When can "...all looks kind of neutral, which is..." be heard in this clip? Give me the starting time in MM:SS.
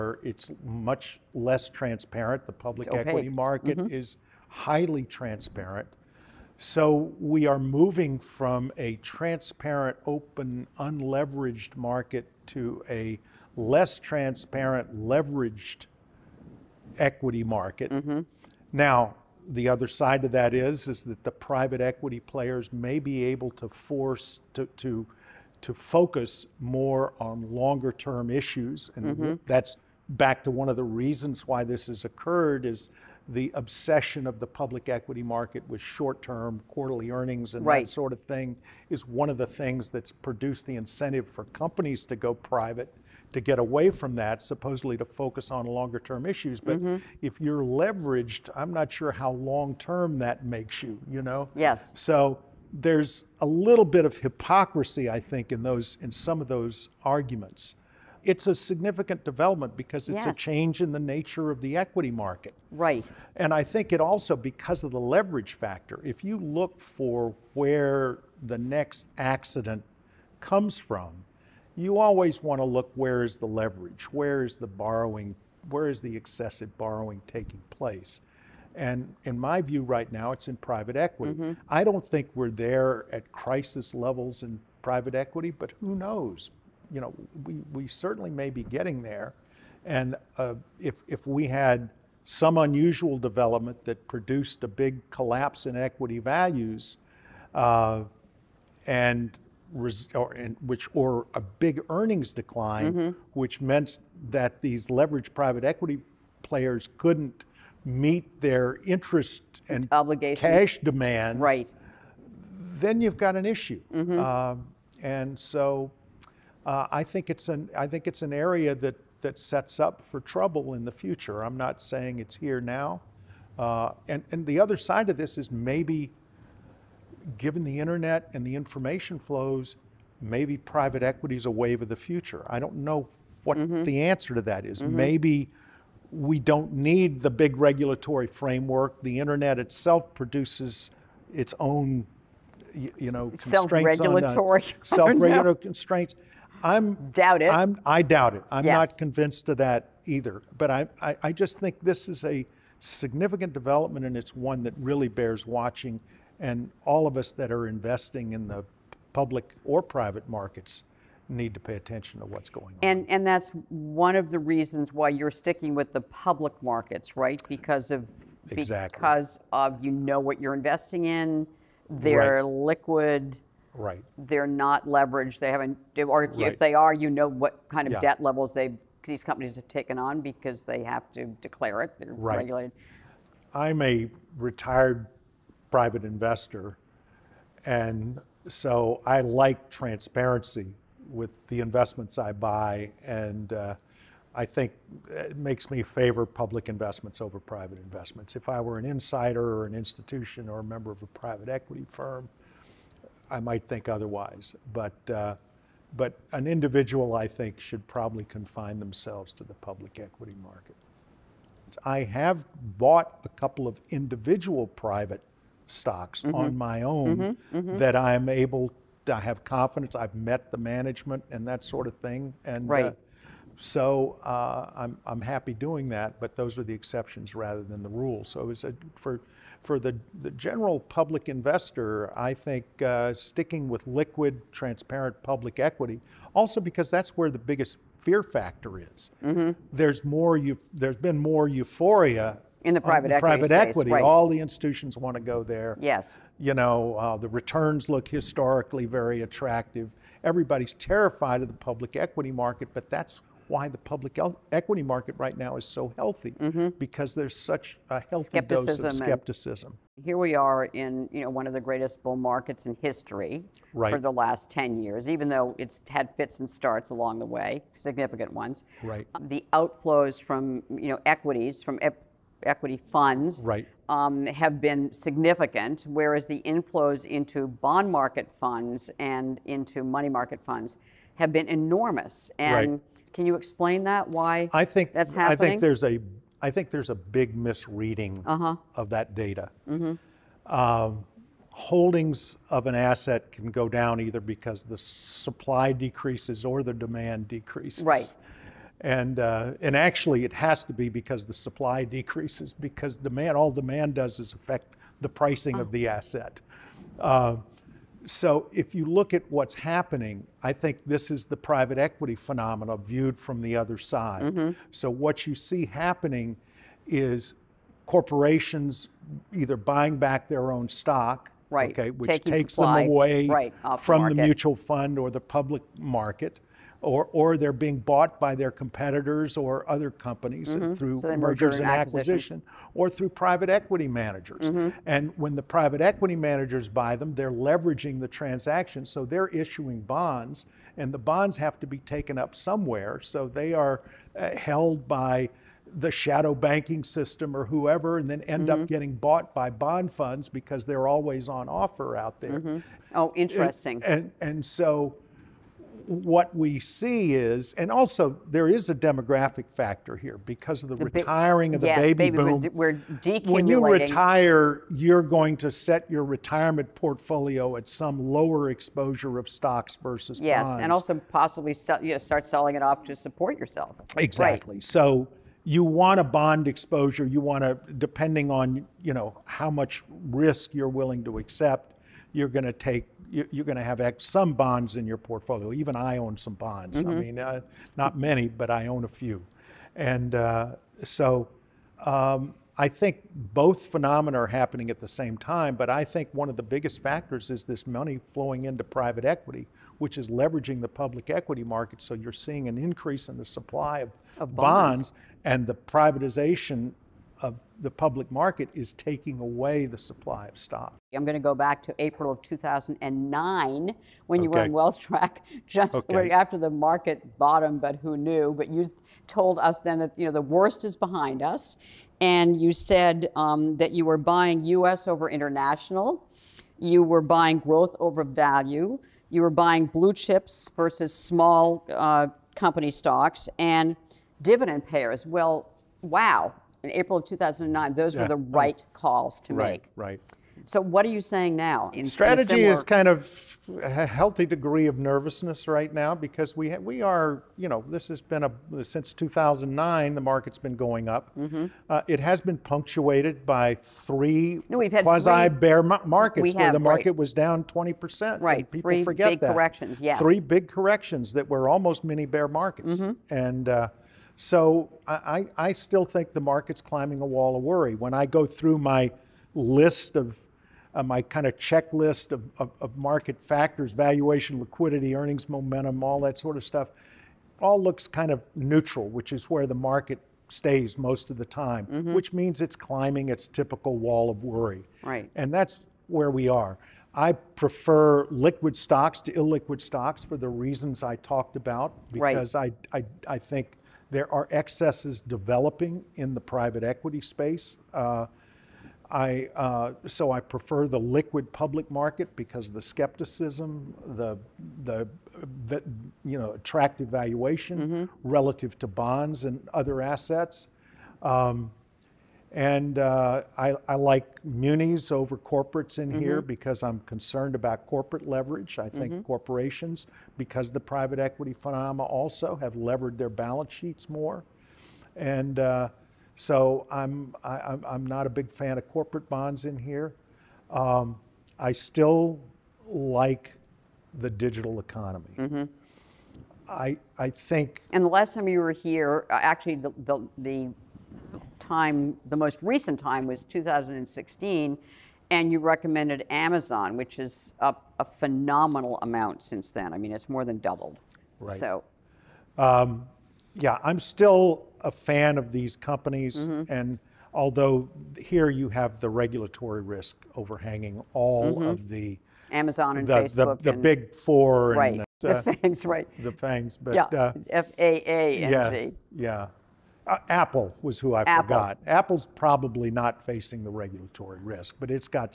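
07:57.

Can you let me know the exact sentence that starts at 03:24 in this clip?
But, uh, but an individual, I think, should probably confine themselves to the public equity market.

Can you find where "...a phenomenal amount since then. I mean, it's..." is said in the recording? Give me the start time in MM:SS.
09:07.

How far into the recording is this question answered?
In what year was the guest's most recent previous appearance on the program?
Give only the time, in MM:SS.
09:03.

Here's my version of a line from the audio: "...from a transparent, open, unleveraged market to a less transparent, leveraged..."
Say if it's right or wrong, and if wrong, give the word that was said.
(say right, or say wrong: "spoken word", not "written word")
right.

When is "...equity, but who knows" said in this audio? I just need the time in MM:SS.
01:25.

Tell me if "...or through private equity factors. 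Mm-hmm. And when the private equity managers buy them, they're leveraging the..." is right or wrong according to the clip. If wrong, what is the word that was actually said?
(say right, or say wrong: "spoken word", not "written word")
wrong: "managers", not "factors".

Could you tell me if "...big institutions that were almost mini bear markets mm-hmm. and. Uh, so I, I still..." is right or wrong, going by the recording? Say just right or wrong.
wrong.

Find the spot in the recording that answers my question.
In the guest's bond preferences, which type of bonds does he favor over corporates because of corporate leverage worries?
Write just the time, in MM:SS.
08:34.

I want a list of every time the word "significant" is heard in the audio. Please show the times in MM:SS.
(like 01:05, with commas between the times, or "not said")
00:58, 02:32, 04:27, 04:34.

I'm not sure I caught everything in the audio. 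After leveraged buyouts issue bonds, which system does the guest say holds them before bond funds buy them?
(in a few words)
Shadow banking system.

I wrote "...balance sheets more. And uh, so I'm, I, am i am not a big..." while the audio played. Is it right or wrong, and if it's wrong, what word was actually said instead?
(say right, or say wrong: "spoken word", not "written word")
right.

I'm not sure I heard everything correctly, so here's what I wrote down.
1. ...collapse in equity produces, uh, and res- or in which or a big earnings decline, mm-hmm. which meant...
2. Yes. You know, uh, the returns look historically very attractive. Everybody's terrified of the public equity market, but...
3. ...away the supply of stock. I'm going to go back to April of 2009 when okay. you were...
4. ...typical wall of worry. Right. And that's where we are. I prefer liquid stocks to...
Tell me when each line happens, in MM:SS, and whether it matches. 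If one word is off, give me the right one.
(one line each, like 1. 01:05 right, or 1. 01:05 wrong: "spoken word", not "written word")
1. 01:35 wrong: "values", not "produces"
2. 04:05 right
3. 06:49 right
4. 08:03 right.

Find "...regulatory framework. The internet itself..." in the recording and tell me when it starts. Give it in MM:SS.
02:17.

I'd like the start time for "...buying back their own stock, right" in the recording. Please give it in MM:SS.
05:19.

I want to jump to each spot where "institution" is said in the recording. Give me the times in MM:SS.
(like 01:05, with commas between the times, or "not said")
03:19, 04:04.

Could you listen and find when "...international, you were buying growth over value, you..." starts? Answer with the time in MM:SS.
07:05.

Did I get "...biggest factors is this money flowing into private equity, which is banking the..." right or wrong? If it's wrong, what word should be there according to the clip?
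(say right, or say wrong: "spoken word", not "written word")
wrong: "leveraging", not "banking".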